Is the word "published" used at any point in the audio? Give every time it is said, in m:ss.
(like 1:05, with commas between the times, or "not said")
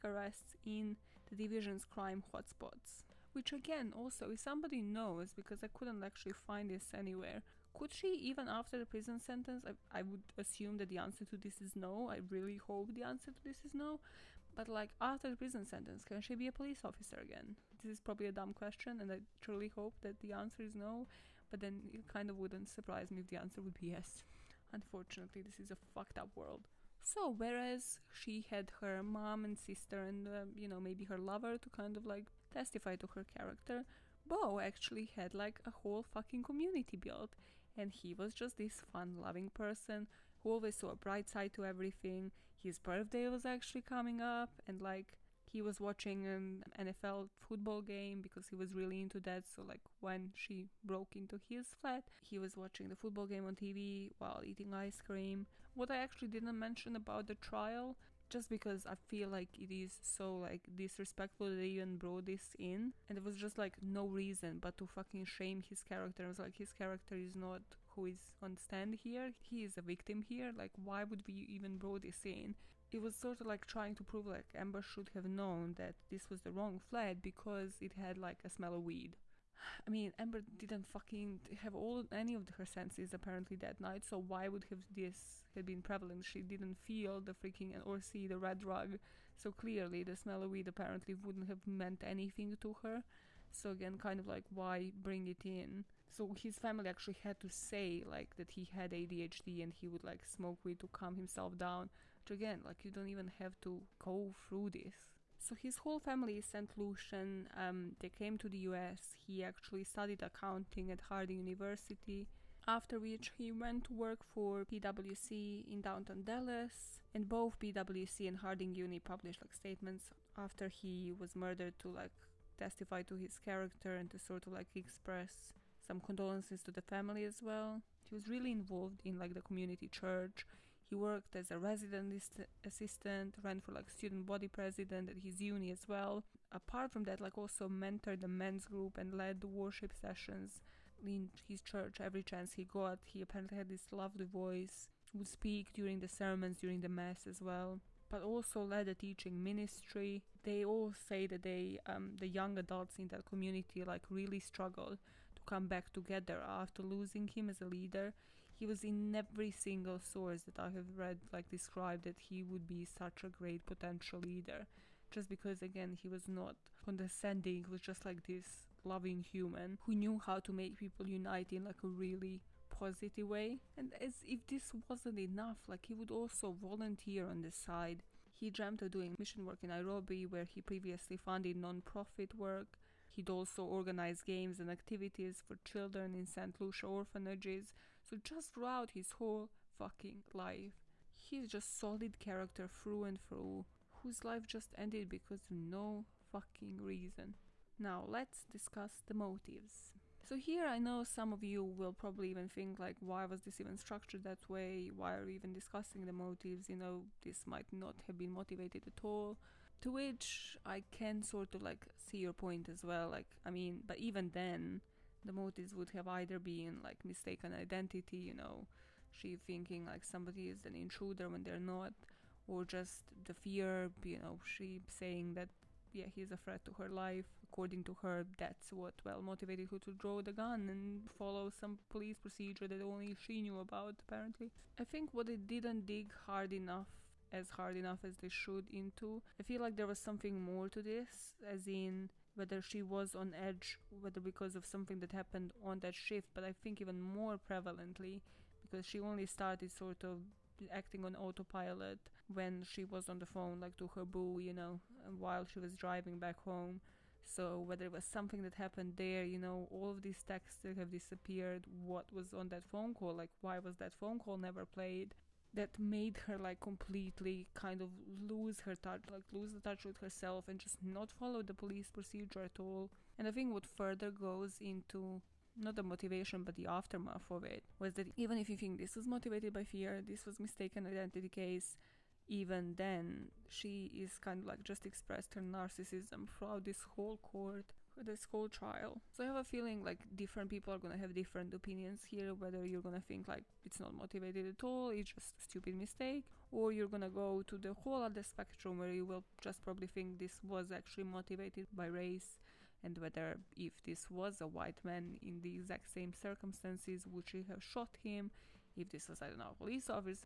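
1:58.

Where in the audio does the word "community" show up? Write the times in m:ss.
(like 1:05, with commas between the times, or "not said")
0:36, 2:09, 2:33.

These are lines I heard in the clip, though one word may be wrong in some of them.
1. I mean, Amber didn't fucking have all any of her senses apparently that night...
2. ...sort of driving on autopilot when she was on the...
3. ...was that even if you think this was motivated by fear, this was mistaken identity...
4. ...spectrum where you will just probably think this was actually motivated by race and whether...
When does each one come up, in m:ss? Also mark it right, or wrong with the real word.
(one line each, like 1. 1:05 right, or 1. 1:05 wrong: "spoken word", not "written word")
1. 1:19 right
2. 4:09 wrong: "acting", not "driving"
3. 4:37 right
4. 4:58 right.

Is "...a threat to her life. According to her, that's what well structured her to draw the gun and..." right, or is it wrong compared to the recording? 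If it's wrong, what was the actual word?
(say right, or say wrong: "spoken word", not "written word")
wrong: "motivated", not "structured".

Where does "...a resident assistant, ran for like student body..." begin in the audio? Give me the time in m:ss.
2:11.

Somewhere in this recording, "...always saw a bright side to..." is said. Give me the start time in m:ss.
0:40.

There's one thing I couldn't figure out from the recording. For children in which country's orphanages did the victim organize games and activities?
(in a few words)
St. Lucia.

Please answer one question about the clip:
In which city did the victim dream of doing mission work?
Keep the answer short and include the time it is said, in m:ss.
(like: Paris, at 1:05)
Nairobi, at 2:59.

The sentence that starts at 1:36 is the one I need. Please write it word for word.
So his family actually had to say like that he had ADHD and he would like smoke weed to calm himself down.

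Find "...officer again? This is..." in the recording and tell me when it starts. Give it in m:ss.
0:16.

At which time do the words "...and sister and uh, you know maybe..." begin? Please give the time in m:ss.
0:29.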